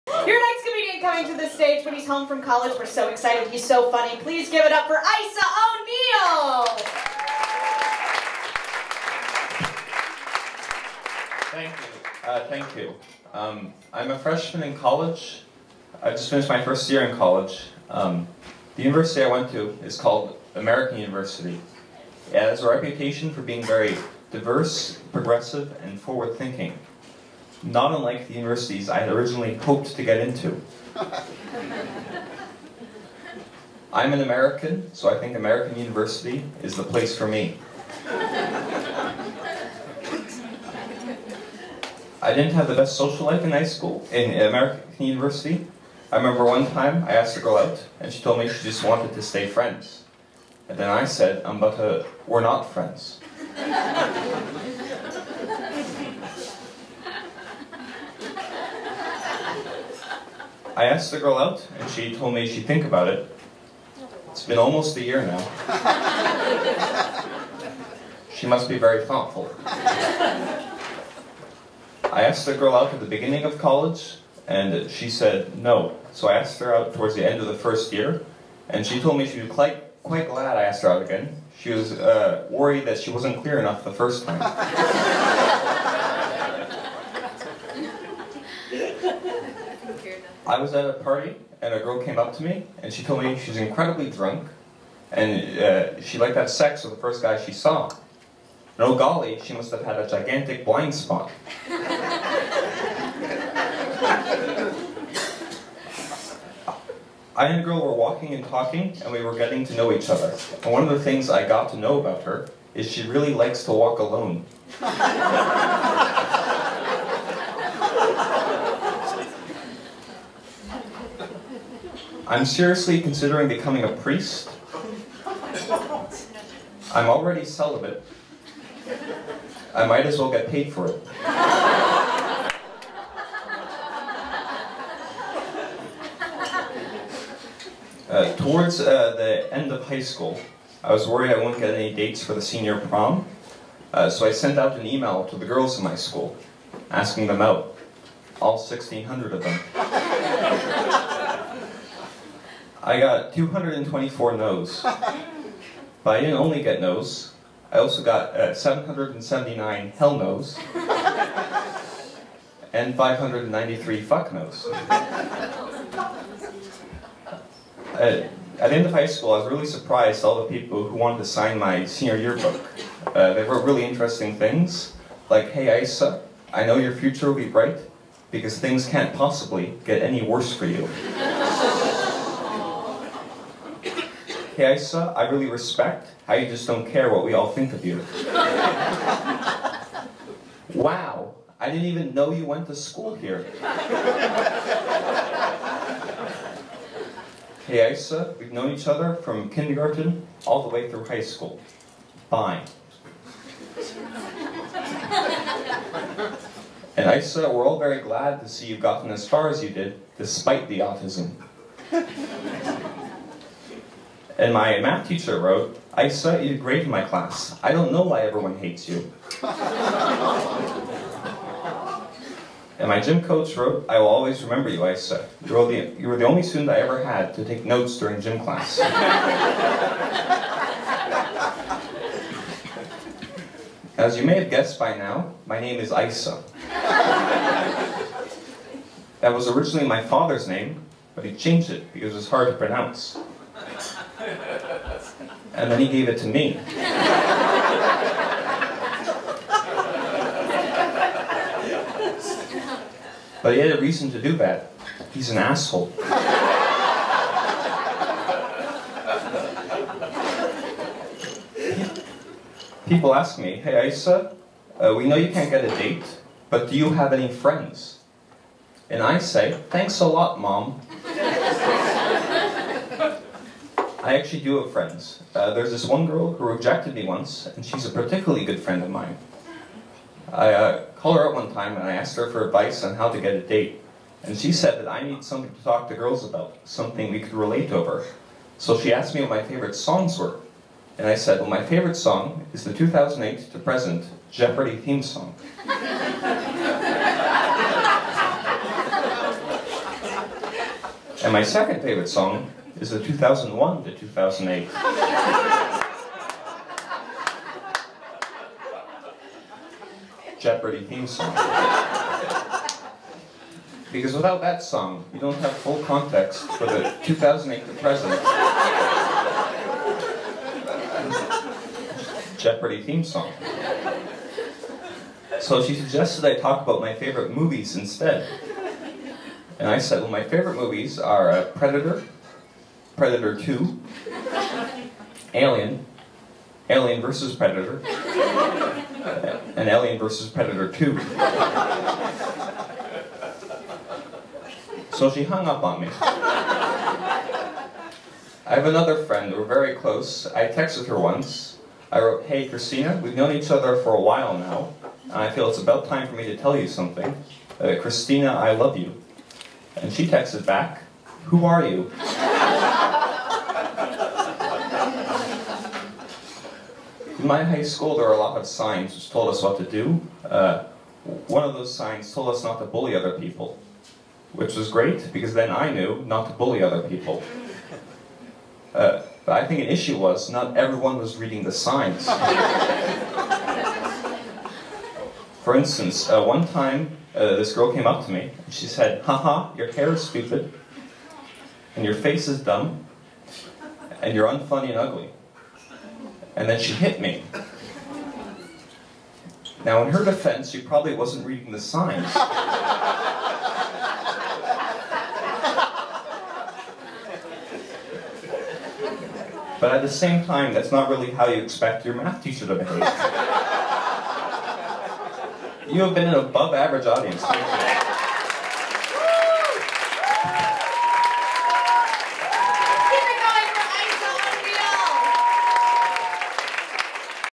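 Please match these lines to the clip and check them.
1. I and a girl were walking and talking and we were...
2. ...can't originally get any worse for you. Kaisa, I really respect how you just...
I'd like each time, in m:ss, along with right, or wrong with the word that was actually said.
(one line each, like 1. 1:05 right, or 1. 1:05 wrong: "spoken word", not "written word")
1. 1:41 right
2. 2:58 wrong: "possibly", not "originally".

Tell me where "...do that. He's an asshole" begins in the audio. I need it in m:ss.
4:14.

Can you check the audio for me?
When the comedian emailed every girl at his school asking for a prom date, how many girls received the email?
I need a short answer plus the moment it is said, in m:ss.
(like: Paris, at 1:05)
1,600, at 2:28.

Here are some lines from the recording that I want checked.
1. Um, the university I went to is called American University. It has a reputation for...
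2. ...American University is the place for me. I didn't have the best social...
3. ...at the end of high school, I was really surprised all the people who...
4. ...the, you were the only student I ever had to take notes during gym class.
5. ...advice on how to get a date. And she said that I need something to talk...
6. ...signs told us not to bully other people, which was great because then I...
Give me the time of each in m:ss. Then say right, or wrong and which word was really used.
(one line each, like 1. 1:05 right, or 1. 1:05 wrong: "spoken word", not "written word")
1. 0:17 right
2. 0:35 right
3. 2:48 right
4. 3:45 right
5. 4:42 right
6. 6:11 right.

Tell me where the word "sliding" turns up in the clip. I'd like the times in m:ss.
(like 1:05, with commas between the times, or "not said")
not said.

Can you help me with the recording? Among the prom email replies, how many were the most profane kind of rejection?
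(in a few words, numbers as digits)
593.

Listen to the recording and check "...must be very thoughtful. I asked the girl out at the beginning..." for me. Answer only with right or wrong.
right.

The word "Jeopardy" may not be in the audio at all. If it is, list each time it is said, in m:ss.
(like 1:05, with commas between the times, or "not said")
4:54, 5:10, 5:22.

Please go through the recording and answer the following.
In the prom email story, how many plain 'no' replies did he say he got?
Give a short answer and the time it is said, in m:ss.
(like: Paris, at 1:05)
224, at 2:33.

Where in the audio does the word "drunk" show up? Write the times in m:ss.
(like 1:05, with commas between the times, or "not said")
1:34.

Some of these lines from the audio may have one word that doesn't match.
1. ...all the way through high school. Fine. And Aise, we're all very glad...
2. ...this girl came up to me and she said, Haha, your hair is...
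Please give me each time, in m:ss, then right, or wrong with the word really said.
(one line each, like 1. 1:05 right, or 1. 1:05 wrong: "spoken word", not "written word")
1. 3:20 right
2. 6:27 right.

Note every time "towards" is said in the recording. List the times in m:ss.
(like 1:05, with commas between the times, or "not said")
1:16, 2:18.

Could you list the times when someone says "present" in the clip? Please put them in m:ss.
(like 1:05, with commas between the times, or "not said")
4:53, 5:17.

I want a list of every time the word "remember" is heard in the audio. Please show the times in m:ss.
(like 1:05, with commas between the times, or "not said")
0:46, 3:44.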